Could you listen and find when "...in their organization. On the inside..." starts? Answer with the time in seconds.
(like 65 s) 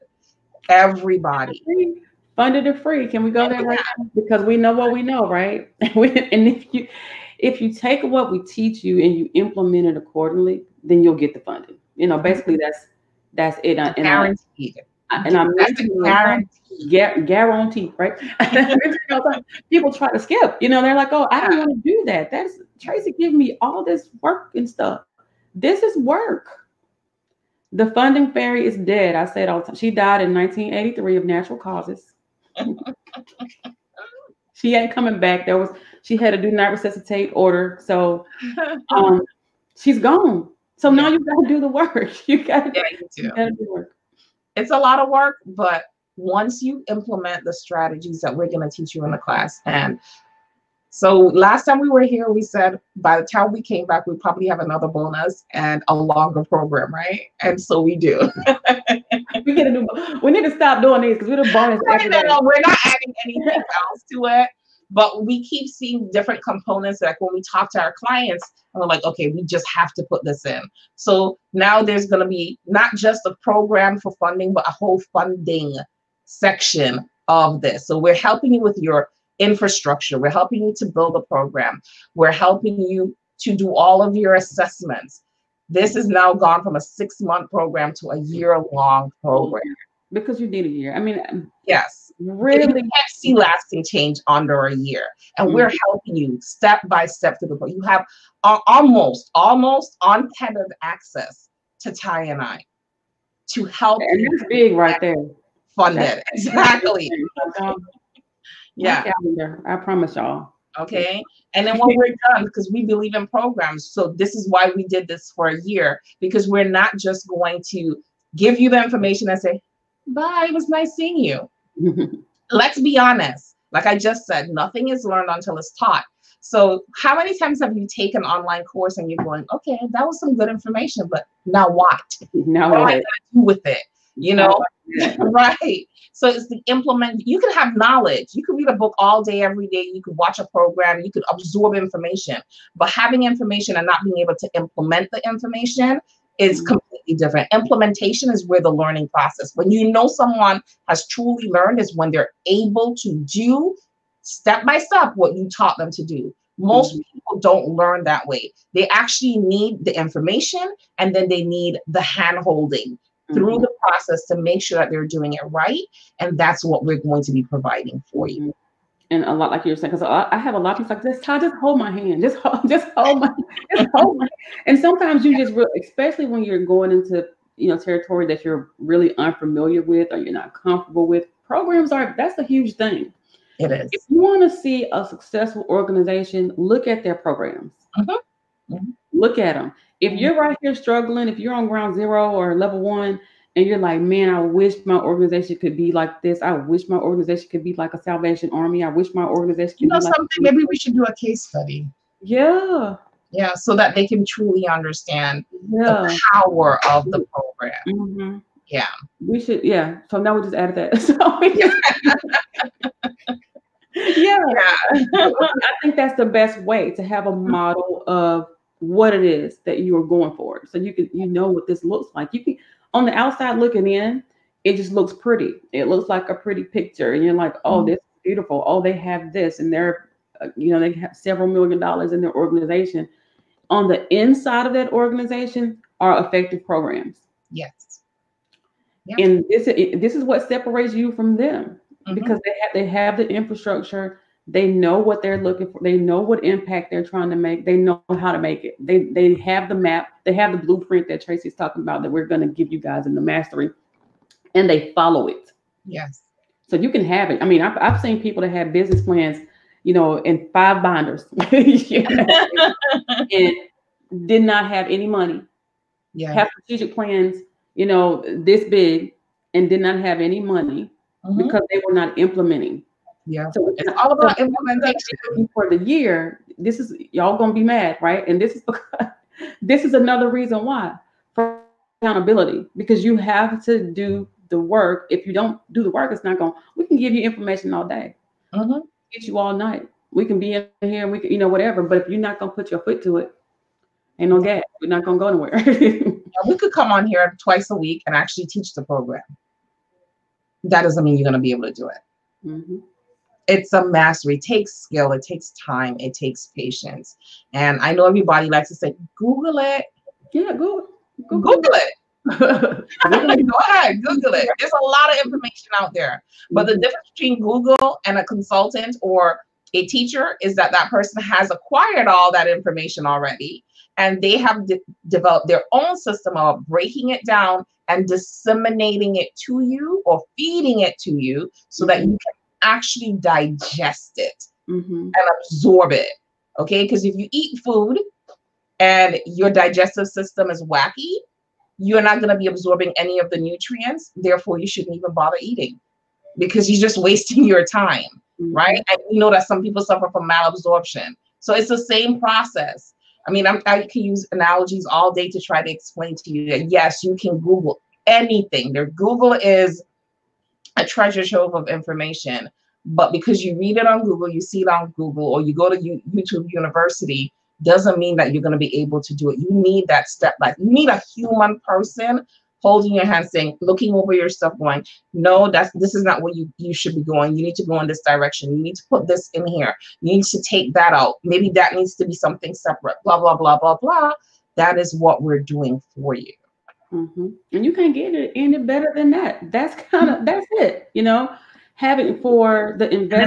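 232 s.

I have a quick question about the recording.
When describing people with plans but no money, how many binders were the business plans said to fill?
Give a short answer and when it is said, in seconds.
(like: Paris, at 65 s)
5, at 260 s.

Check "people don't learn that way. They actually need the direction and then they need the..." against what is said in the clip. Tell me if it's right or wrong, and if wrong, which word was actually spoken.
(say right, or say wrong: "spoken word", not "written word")
wrong: "information", not "direction".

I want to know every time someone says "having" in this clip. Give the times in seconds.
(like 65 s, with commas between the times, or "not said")
142 s, 391 s.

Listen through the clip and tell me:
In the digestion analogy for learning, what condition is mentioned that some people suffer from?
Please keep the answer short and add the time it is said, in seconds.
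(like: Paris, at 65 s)
malabsorption, at 350 s.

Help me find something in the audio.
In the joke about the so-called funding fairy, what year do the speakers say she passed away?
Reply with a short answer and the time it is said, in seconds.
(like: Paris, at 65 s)
1983, at 30 s.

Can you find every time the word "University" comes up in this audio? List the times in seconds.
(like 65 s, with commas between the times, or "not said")
366 s.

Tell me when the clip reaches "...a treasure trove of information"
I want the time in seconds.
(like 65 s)
360 s.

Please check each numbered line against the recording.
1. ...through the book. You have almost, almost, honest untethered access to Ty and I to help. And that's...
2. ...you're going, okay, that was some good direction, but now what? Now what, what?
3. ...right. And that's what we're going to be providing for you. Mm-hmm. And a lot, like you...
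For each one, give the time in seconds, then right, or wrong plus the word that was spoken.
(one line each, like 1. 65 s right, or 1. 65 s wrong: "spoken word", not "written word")
1. 97 s wrong: "almost", not "honest"
2. 129 s wrong: "information", not "direction"
3. 165 s right.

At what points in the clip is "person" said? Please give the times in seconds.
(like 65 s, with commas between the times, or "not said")
320 s, 371 s.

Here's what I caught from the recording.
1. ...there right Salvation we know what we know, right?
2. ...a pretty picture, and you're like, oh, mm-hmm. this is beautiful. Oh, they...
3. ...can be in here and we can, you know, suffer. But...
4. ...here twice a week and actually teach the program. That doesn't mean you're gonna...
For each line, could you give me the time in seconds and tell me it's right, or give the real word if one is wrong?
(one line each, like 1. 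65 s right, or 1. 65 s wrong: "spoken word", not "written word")
1. 3 s wrong: "Because", not "Salvation"
2. 226 s right
3. 290 s wrong: "whatever", not "suffer"
4. 297 s right.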